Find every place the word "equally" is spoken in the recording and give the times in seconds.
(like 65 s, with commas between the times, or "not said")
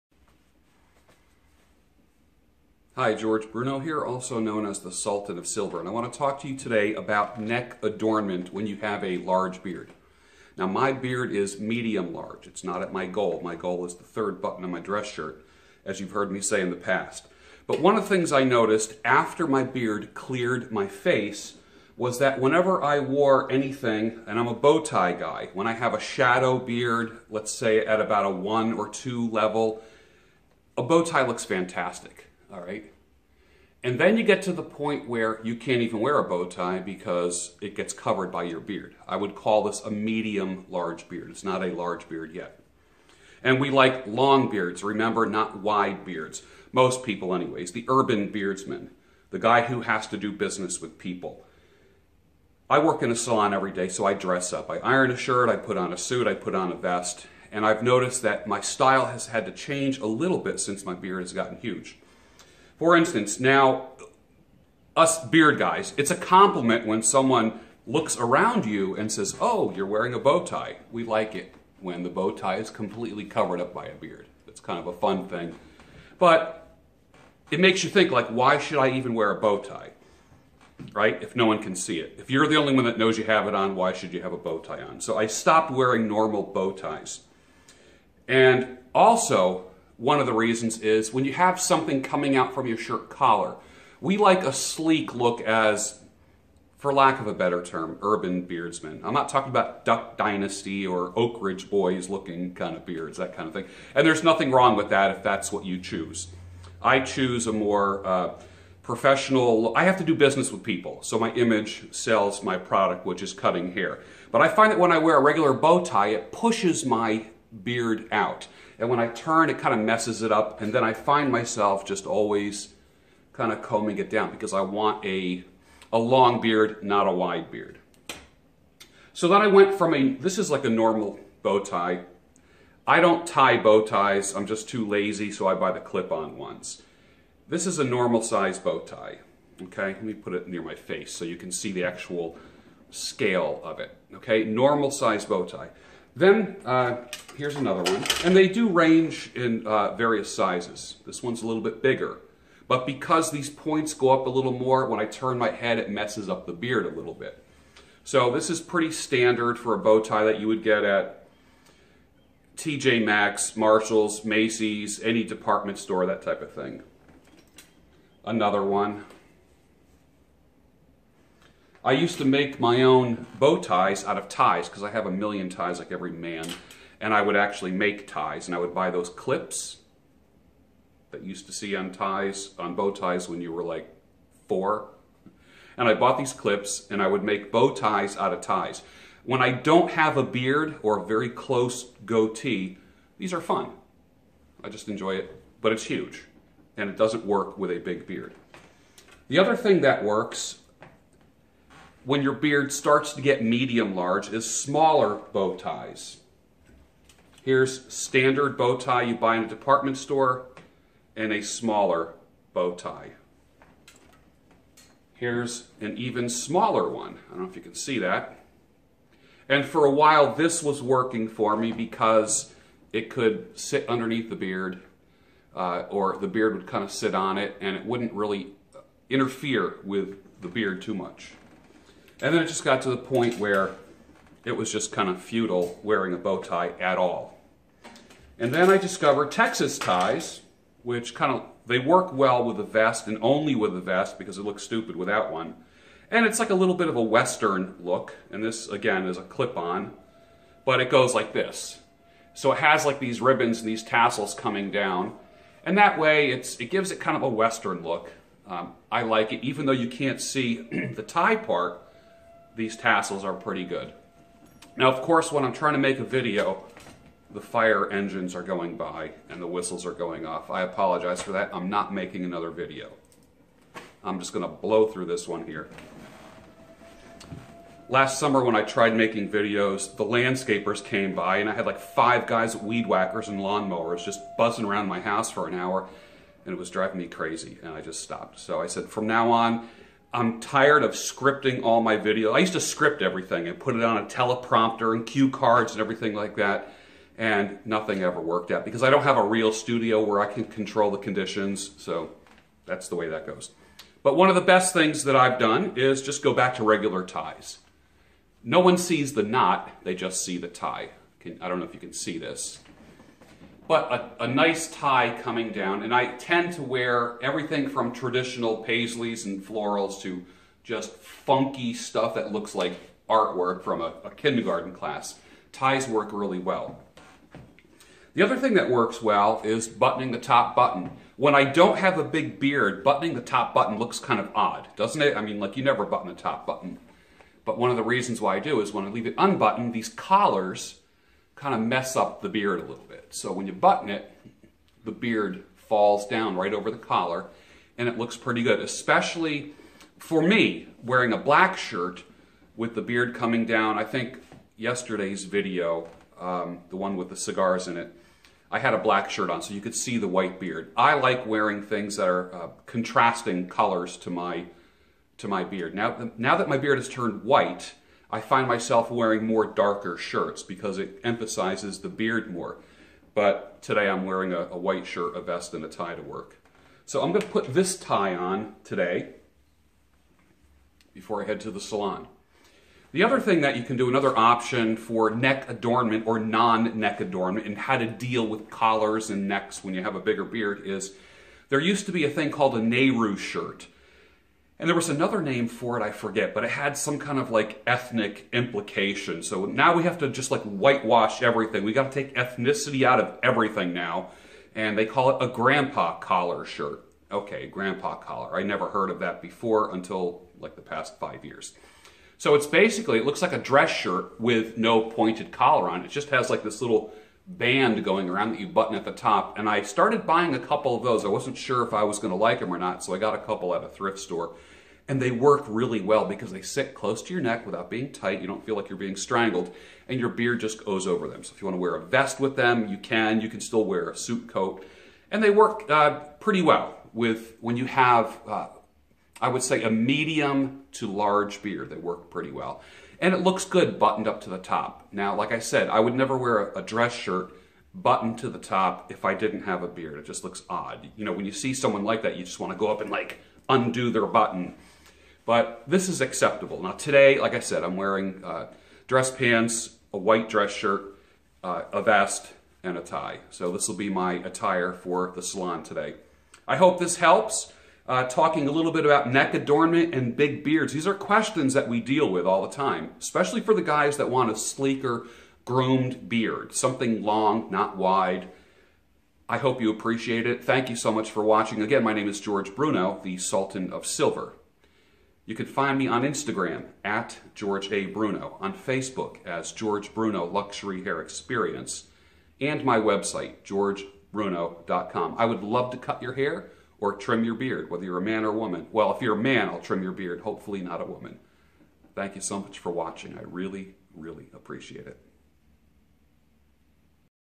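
not said.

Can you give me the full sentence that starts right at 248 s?
And this, again, is a clip-on, but it goes like this.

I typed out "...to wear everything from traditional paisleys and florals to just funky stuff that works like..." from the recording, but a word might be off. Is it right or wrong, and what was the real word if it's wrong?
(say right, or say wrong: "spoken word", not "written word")
wrong: "looks", not "works".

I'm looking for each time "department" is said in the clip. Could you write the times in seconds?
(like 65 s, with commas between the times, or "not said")
165 s, 209 s.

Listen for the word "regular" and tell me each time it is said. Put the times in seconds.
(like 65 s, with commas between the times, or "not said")
115 s, 306 s.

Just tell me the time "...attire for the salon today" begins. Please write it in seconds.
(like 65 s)
464 s.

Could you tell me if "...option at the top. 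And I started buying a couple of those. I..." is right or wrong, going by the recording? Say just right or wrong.
wrong.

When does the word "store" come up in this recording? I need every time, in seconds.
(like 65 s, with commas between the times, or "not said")
165 s, 209 s, 423 s.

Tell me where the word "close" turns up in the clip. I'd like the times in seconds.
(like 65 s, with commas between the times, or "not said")
191 s, 426 s.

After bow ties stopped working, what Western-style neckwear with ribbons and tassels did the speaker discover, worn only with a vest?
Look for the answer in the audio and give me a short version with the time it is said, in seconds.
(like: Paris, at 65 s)
Texas ties, at 239 s.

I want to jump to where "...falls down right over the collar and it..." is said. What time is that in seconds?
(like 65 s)
345 s.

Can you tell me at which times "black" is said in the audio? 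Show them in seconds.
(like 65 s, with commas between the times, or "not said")
351 s, 358 s.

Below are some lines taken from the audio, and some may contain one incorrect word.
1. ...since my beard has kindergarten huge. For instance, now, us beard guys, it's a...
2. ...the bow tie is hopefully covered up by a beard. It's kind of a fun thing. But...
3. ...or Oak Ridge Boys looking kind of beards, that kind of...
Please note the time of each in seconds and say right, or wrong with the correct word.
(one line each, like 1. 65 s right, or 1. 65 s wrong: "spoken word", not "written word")
1. 60 s wrong: "gotten", not "kindergarten"
2. 72 s wrong: "completely", not "hopefully"
3. 100 s right.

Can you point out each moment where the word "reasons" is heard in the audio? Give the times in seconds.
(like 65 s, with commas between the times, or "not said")
90 s, 337 s.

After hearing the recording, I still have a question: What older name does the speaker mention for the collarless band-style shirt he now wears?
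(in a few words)
Nehru shirt.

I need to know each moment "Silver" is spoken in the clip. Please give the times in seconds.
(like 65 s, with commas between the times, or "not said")
5 s, 483 s.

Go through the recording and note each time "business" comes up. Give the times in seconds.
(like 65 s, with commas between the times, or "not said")
50 s, 110 s.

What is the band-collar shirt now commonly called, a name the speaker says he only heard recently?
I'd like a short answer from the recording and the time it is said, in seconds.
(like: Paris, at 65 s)
grandpa collar shirt, at 405 s.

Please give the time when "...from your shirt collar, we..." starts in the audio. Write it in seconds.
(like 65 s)
92 s.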